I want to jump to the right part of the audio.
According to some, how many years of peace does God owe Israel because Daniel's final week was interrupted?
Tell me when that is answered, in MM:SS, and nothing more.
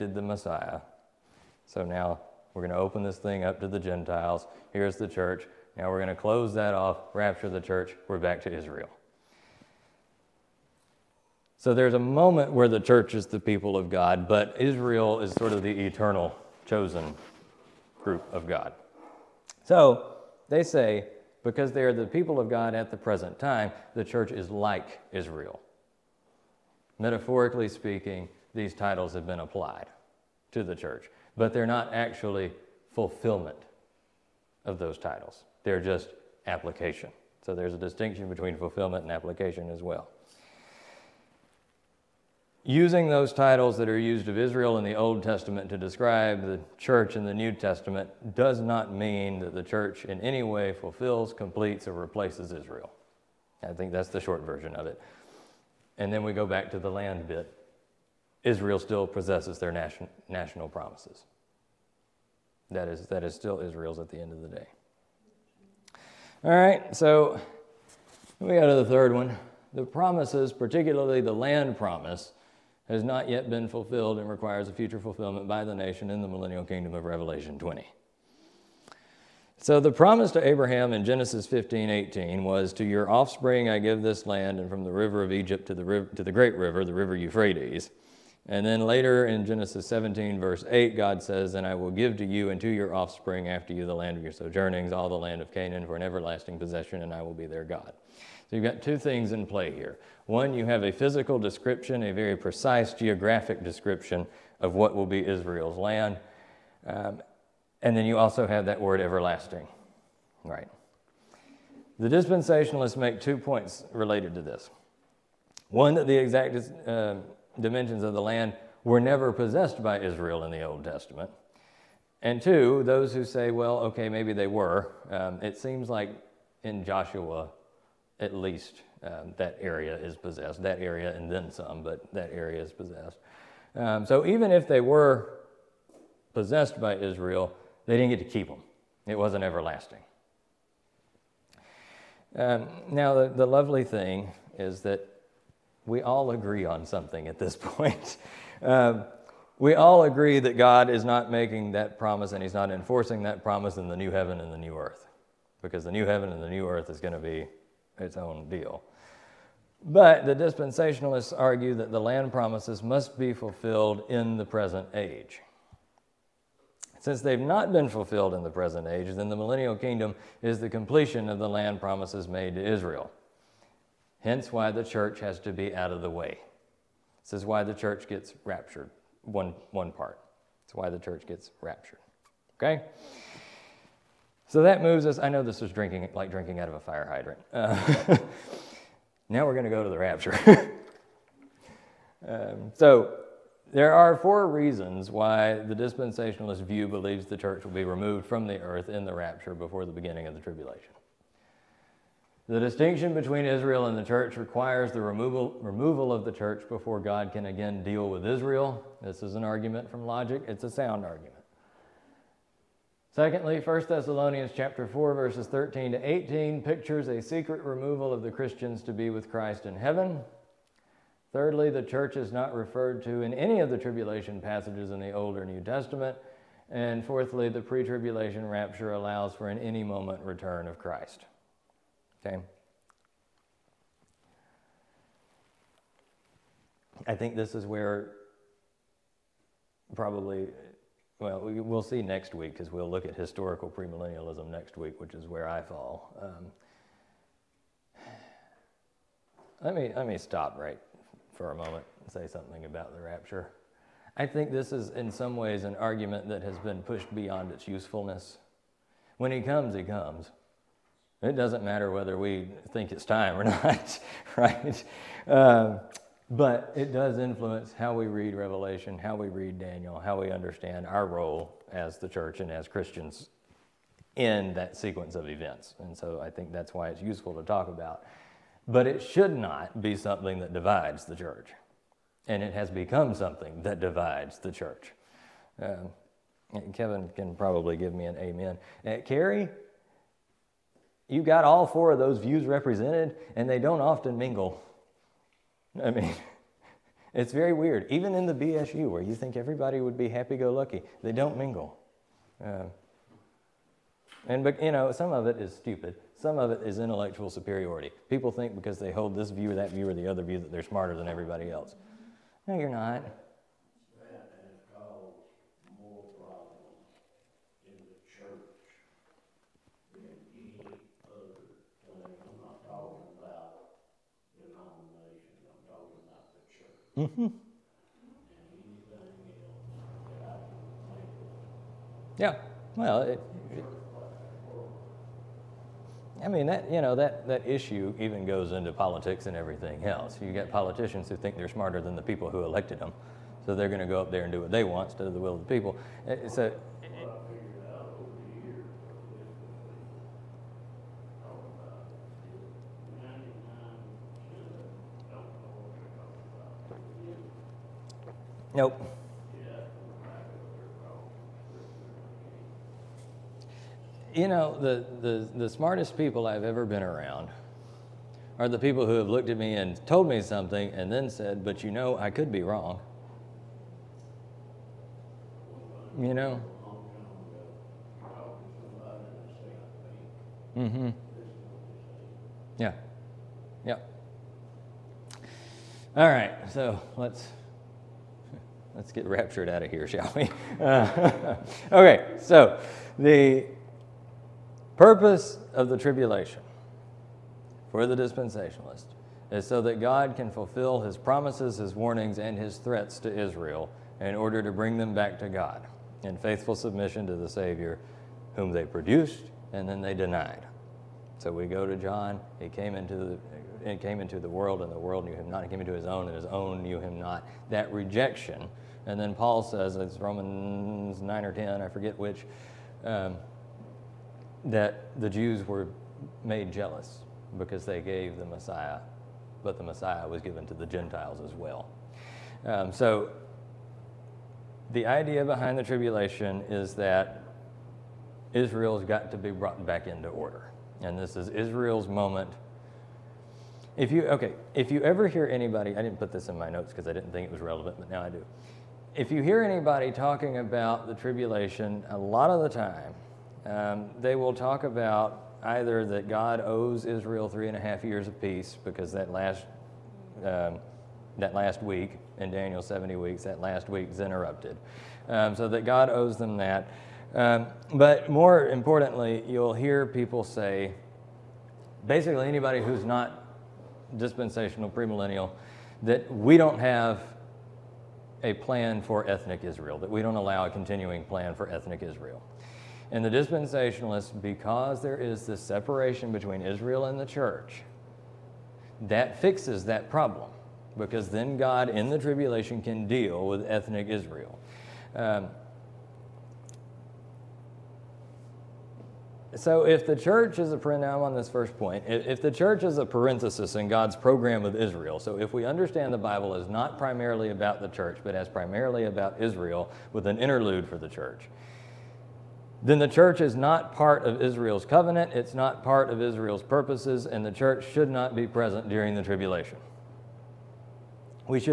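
07:37.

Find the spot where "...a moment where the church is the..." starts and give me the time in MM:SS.
00:11.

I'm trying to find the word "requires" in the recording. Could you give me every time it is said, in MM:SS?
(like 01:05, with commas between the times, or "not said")
01:14, 03:24.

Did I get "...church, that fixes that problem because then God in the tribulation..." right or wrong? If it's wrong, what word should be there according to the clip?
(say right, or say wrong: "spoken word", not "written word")
right.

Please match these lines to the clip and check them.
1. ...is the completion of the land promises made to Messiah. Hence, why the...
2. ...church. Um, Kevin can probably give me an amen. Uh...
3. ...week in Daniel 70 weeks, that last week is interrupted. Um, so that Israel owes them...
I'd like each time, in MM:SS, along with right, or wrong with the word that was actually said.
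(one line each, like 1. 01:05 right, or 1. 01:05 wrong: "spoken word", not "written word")
1. 02:50 wrong: "Israel", not "Messiah"
2. 04:44 right
3. 07:41 wrong: "God", not "Israel".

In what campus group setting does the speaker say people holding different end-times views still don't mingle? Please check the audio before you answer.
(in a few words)
BSU.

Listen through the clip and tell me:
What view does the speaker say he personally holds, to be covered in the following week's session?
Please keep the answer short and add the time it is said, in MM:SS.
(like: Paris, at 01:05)
historical premillennialism, at 04:03.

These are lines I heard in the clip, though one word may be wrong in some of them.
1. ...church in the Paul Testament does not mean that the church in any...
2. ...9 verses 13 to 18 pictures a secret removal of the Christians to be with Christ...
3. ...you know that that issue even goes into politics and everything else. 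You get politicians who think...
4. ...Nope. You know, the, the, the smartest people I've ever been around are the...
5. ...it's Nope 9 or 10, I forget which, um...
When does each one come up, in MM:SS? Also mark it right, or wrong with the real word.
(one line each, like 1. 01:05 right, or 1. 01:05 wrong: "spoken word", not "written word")
1. 00:46 wrong: "New", not "Paul"
2. 03:34 wrong: "4", not "9"
3. 05:36 right
4. 05:58 right
5. 06:59 wrong: "Romans", not "Nope".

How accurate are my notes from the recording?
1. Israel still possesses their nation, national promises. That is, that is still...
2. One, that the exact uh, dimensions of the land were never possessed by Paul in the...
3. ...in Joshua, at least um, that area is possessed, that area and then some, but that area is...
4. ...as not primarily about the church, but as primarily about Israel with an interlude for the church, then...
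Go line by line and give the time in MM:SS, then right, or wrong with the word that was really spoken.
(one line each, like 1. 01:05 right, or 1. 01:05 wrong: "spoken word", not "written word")
1. 00:58 right
2. 01:55 wrong: "Israel", not "Paul"
3. 02:06 right
4. 08:26 right.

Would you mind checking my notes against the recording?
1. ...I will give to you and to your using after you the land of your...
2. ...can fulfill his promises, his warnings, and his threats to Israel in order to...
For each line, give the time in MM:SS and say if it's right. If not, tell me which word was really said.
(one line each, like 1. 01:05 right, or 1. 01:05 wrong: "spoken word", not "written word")
1. 01:31 wrong: "offspring", not "using"
2. 06:40 right.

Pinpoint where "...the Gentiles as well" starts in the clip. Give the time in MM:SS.
07:10.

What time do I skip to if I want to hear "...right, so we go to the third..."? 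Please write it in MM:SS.
01:06.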